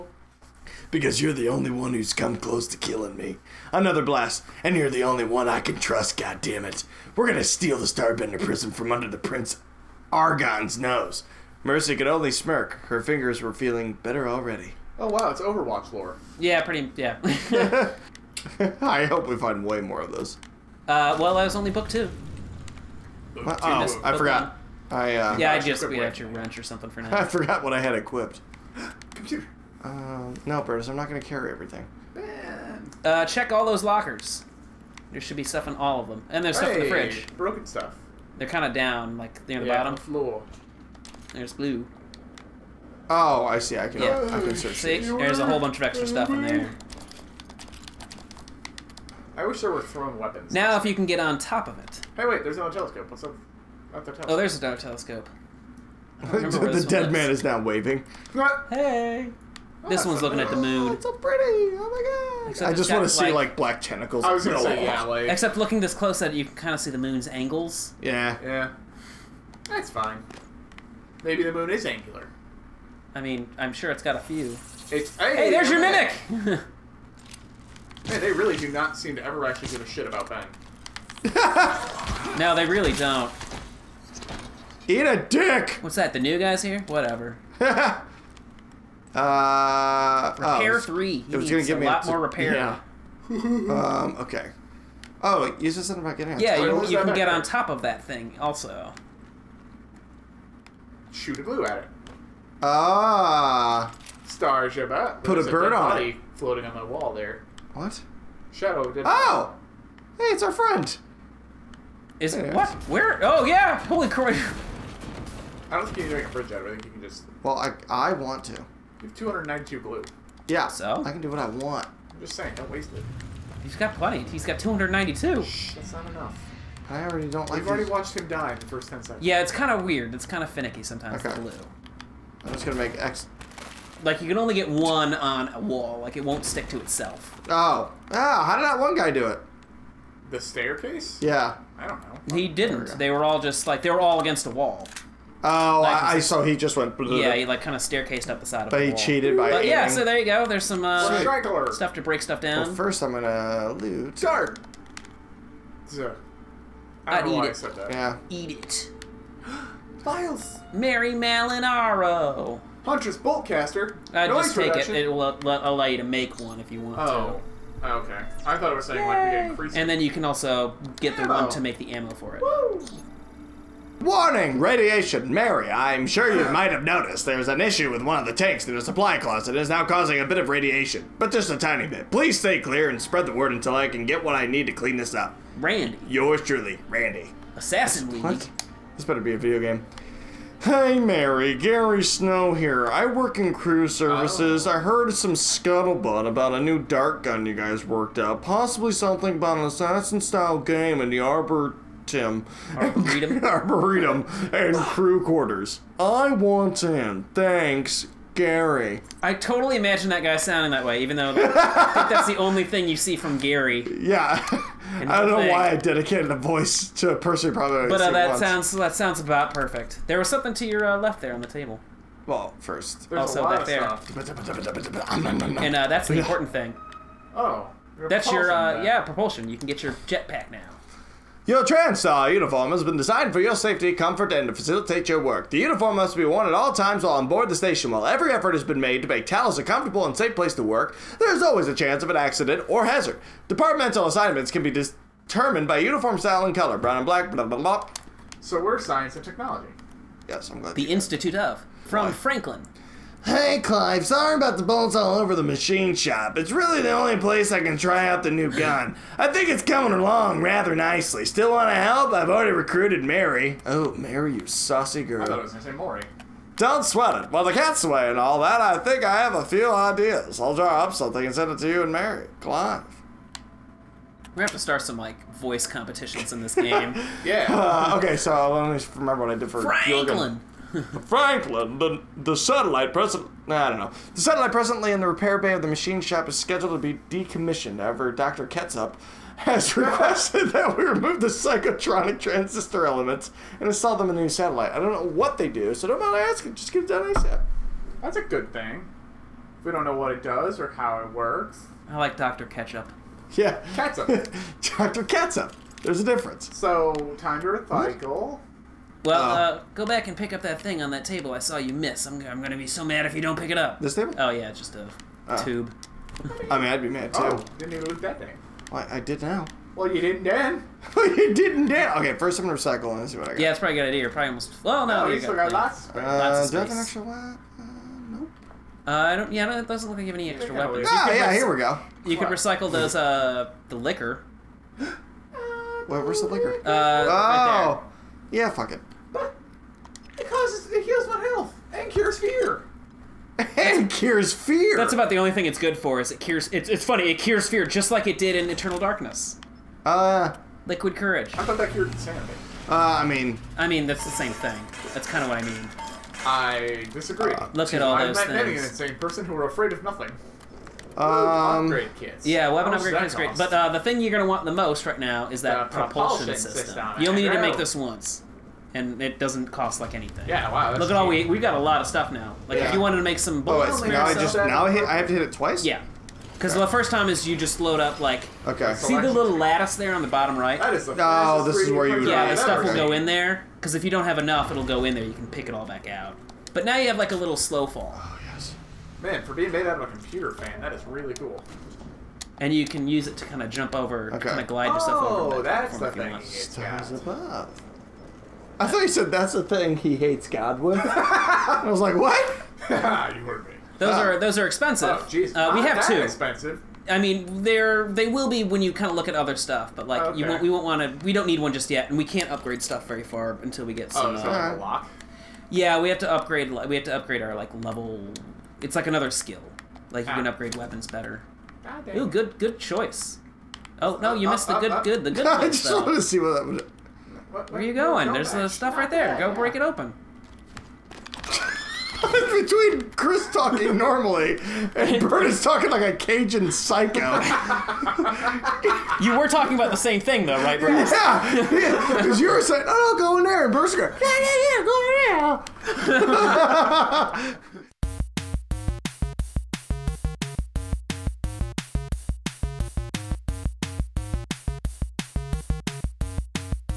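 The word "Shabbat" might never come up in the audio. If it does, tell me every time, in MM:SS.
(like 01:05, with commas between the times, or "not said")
01:44.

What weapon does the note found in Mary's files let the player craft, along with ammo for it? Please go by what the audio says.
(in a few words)
Huntress Boltcaster.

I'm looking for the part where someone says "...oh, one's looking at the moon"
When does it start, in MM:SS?
01:00.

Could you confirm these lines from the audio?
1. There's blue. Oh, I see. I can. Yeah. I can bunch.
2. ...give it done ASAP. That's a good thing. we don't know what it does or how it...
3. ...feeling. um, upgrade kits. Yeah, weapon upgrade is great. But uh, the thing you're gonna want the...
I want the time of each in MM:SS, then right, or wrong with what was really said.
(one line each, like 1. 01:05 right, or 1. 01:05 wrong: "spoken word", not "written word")
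1. 00:41 wrong: "search", not "bunch"
2. 04:56 right
3. 05:59 wrong: "nothing", not "feeling".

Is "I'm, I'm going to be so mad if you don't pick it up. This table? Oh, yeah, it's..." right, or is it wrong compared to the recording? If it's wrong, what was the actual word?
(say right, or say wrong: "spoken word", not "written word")
right.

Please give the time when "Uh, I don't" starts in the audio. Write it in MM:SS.
05:28.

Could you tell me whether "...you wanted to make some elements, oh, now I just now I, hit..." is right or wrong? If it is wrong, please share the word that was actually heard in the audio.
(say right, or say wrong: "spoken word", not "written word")
wrong: "bullets", not "elements".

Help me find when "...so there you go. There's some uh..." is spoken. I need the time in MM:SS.
02:29.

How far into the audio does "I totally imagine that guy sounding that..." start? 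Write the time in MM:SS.
03:29.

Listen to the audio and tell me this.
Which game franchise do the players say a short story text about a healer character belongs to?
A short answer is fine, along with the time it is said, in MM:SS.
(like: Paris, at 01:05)
Overwatch, at 00:15.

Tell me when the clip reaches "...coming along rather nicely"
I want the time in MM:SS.
04:19.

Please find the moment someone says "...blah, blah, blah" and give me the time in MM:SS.
04:07.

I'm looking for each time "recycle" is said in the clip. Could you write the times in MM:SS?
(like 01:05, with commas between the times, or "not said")
05:07, 05:22, 05:32.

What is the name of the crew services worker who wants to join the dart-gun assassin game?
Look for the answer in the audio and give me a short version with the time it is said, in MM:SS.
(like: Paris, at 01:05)
Gary Snow, at 03:11.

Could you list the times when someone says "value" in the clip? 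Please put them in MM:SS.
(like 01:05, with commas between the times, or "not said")
not said.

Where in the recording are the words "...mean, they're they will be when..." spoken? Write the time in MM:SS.
06:46.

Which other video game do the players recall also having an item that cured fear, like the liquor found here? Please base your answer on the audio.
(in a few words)
Eternal Darkness.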